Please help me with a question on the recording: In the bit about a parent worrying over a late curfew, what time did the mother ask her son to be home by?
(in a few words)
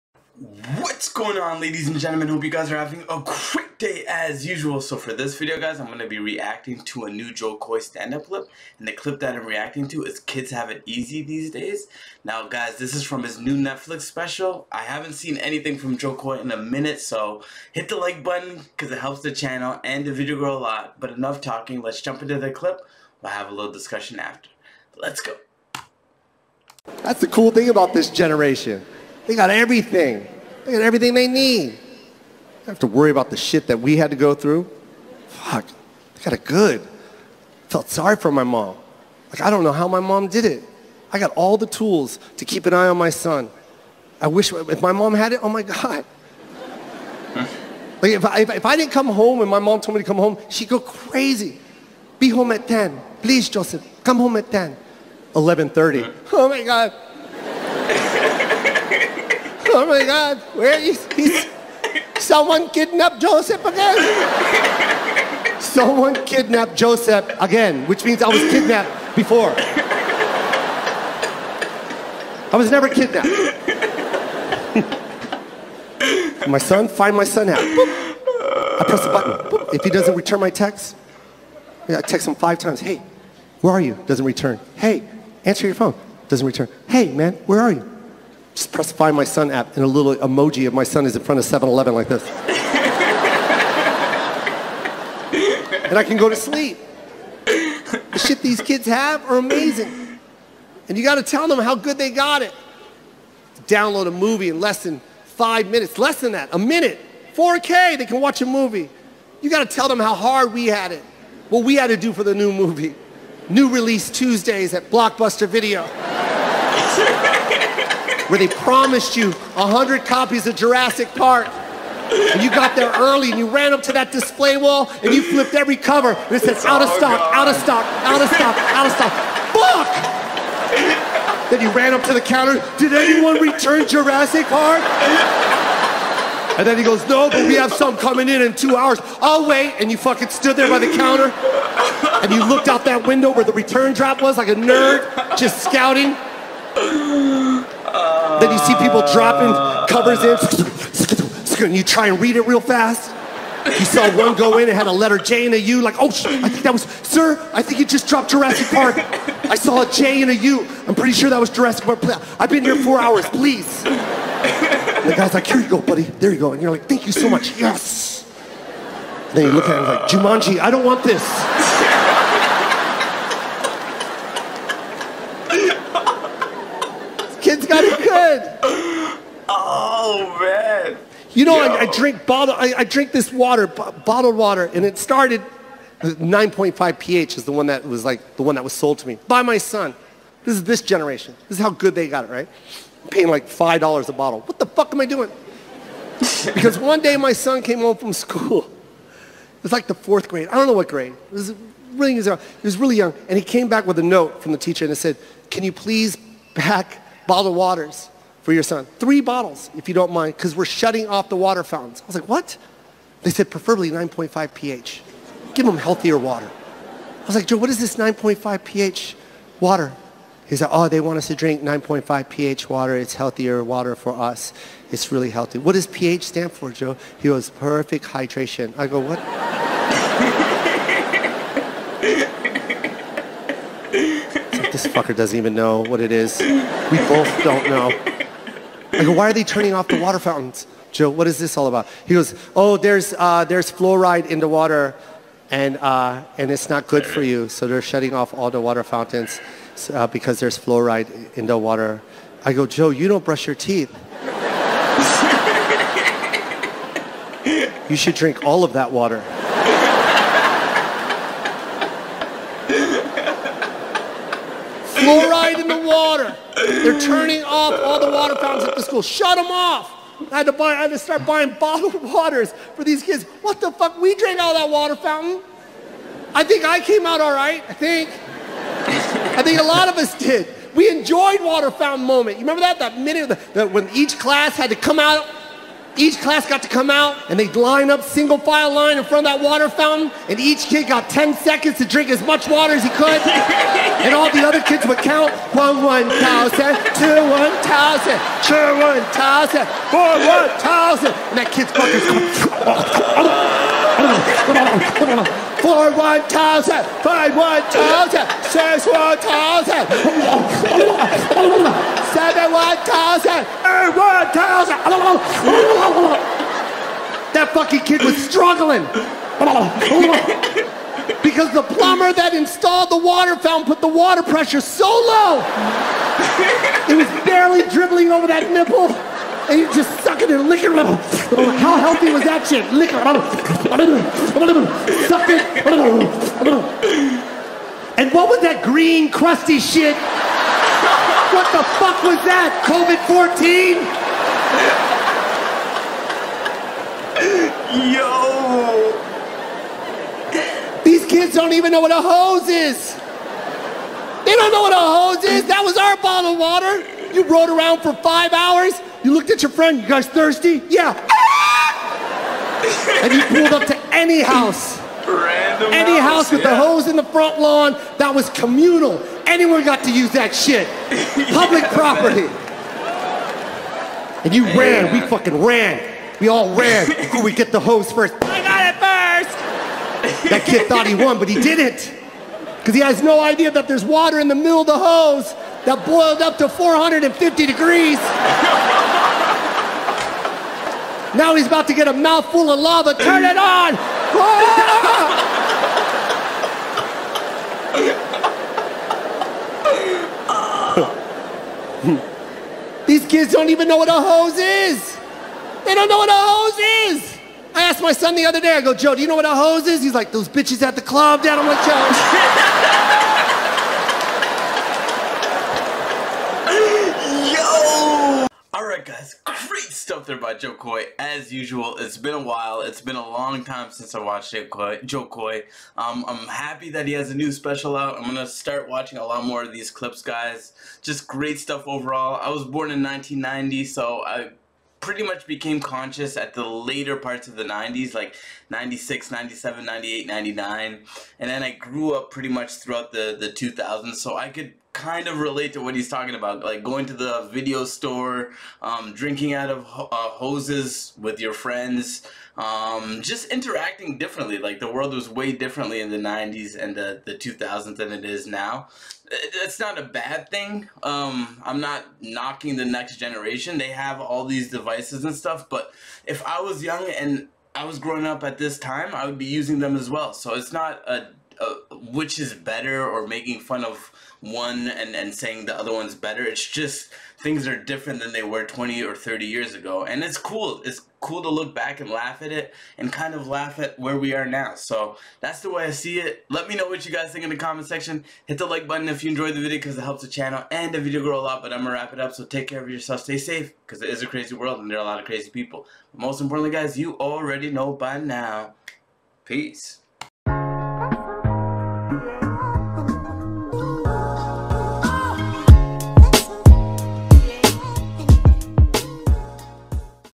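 10.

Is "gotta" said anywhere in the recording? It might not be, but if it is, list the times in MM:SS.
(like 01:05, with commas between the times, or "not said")
01:41, 01:49.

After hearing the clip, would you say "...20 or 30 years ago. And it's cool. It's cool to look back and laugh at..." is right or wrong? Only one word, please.
right.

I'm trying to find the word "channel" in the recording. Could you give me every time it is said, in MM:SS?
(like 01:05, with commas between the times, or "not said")
00:19, 08:10.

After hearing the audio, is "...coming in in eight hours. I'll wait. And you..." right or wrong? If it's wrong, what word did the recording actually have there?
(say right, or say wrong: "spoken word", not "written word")
wrong: "two", not "eight".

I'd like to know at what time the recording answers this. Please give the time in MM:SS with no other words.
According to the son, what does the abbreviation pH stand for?
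03:47.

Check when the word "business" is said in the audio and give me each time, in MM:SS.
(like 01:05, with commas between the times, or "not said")
not said.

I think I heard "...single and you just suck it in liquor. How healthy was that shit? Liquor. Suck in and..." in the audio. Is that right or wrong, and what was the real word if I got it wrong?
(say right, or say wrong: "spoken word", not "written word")
wrong: "nipple", not "single".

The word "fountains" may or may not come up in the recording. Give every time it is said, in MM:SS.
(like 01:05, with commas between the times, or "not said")
03:31, 04:00, 04:08, 04:28, 04:34, 04:41, 04:49, 05:23.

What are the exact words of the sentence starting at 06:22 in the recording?
Because he has no idea that there's water in the middle of the hose that boiled up to 450 degrees.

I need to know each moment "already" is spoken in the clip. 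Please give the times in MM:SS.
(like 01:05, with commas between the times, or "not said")
08:16.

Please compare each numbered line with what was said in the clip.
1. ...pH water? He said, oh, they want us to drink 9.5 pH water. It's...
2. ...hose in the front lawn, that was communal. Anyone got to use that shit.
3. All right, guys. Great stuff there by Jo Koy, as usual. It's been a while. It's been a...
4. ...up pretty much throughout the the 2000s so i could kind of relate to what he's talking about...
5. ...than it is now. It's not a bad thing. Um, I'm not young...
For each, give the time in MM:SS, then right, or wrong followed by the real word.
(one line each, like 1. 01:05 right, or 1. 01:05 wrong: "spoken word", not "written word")
1. 03:38 right
2. 06:06 right
3. 06:58 right
4. 07:21 right
5. 07:37 wrong: "knocking", not "young".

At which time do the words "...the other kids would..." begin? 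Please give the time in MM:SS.
04:54.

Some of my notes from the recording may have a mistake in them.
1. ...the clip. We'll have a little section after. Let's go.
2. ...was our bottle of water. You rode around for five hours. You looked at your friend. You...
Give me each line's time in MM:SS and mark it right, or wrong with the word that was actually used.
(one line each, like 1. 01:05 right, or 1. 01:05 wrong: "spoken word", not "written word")
1. 00:22 wrong: "discussion", not "section"
2. 05:55 right.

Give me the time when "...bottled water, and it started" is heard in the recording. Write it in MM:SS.
03:03.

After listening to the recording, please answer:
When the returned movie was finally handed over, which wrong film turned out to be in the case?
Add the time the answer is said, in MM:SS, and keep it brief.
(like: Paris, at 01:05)
Jumanji, at 02:50.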